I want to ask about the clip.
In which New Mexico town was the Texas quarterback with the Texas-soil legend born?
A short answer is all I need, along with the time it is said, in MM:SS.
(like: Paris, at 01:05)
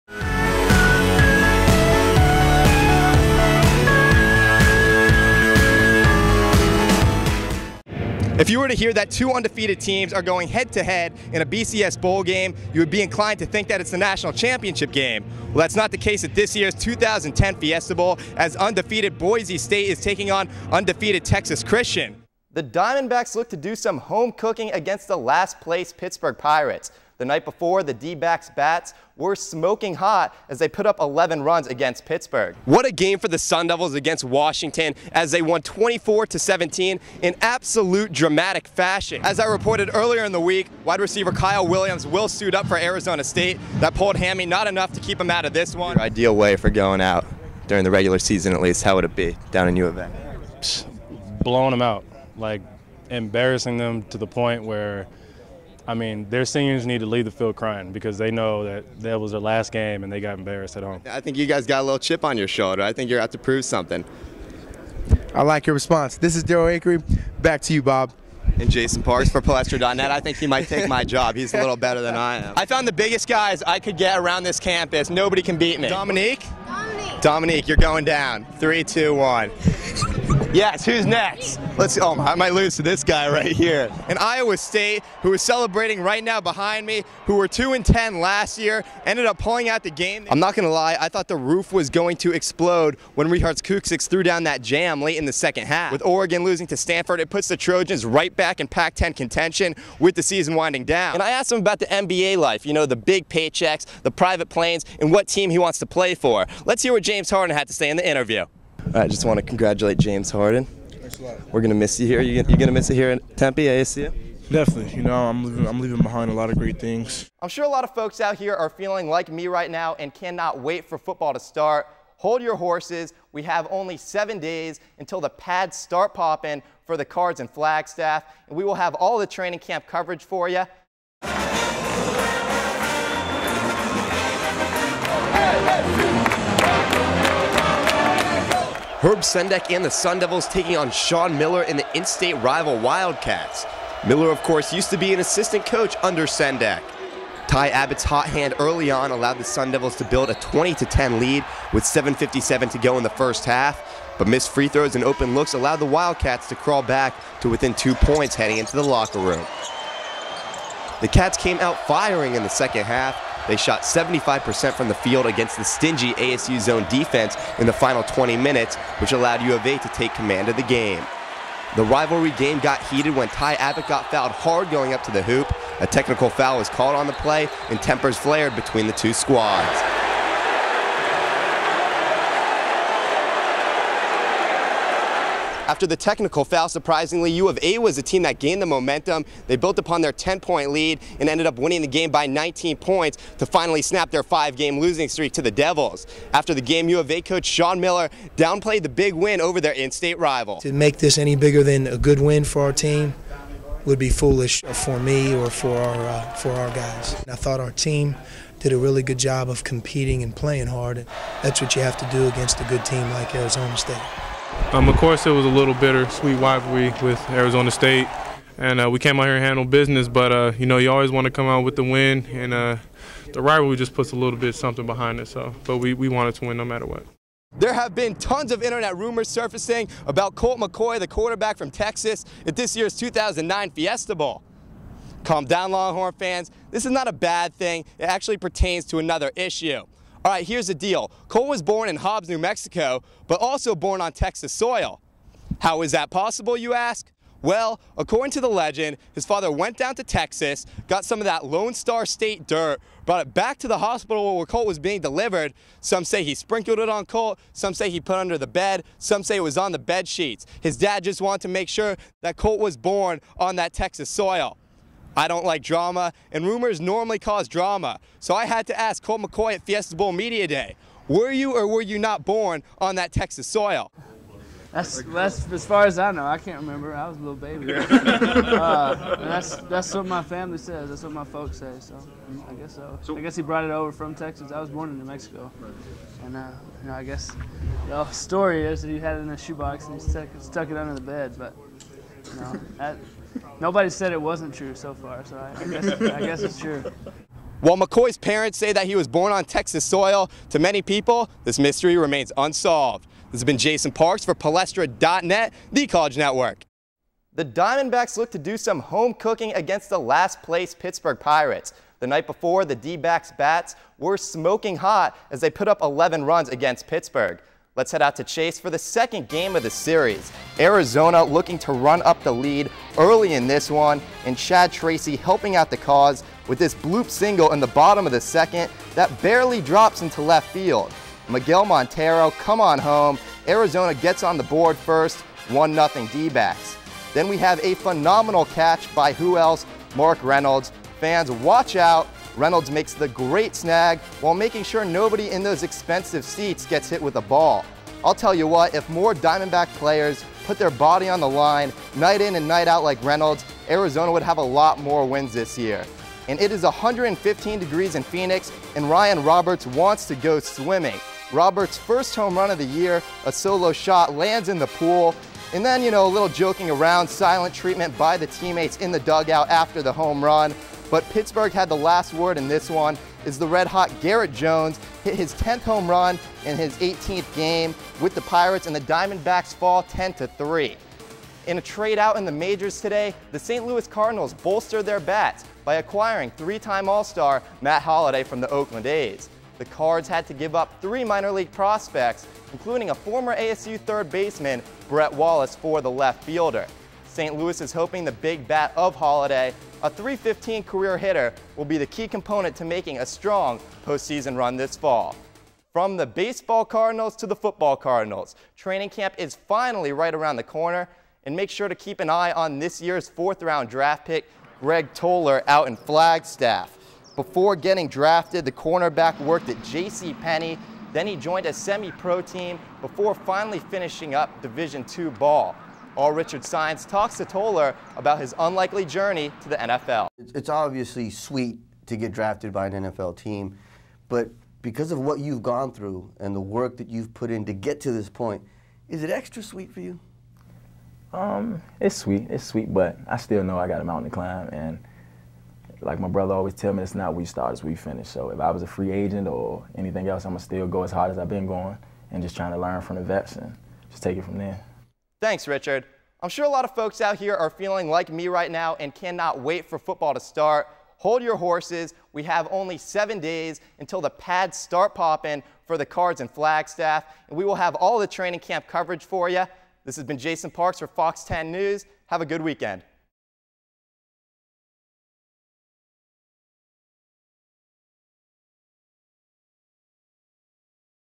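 Hobbs, at 04:01.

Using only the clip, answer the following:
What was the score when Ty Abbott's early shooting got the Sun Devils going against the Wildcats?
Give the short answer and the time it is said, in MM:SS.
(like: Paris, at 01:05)
20-10, at 02:30.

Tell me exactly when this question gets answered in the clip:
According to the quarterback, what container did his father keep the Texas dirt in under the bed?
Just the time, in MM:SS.
04:49.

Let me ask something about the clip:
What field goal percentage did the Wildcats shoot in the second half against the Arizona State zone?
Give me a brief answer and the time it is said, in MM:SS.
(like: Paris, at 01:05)
75%, at 02:43.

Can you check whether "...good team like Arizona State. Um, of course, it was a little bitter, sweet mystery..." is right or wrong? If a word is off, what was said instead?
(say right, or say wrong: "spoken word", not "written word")
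wrong: "rivalry", not "mystery".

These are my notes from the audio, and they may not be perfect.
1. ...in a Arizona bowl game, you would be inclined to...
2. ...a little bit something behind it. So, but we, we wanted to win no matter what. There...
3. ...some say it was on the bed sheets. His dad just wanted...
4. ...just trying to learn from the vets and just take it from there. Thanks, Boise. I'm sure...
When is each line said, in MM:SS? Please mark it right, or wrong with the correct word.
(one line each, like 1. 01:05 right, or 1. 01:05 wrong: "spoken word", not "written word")
1. 00:11 wrong: "BCS", not "Arizona"
2. 03:44 right
3. 04:18 right
4. 07:32 wrong: "Richard", not "Boise".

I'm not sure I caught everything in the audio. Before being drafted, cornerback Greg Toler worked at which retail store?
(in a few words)
J.C. Penney.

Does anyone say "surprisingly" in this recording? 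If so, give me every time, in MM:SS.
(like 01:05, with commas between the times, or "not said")
03:06.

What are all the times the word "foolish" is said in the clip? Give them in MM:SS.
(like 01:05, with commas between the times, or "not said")
03:24.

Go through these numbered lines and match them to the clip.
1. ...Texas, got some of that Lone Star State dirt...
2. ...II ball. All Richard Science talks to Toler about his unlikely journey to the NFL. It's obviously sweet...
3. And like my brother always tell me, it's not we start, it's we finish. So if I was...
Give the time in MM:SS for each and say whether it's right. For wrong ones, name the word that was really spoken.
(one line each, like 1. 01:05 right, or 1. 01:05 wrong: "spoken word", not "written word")
1. 04:10 right
2. 07:04 right
3. 07:24 right.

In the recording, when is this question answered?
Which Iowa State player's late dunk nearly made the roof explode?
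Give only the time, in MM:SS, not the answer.
01:33.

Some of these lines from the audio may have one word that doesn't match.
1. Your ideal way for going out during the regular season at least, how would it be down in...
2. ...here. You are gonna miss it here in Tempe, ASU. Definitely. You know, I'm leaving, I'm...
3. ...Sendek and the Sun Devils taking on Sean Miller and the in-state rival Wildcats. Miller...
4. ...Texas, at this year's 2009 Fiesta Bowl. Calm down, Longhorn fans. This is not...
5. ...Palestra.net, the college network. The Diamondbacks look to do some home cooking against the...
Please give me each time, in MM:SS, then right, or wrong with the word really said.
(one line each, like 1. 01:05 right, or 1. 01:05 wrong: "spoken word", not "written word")
1. 00:45 right
2. 01:52 right
3. 02:19 right
4. 03:51 right
5. 05:04 right.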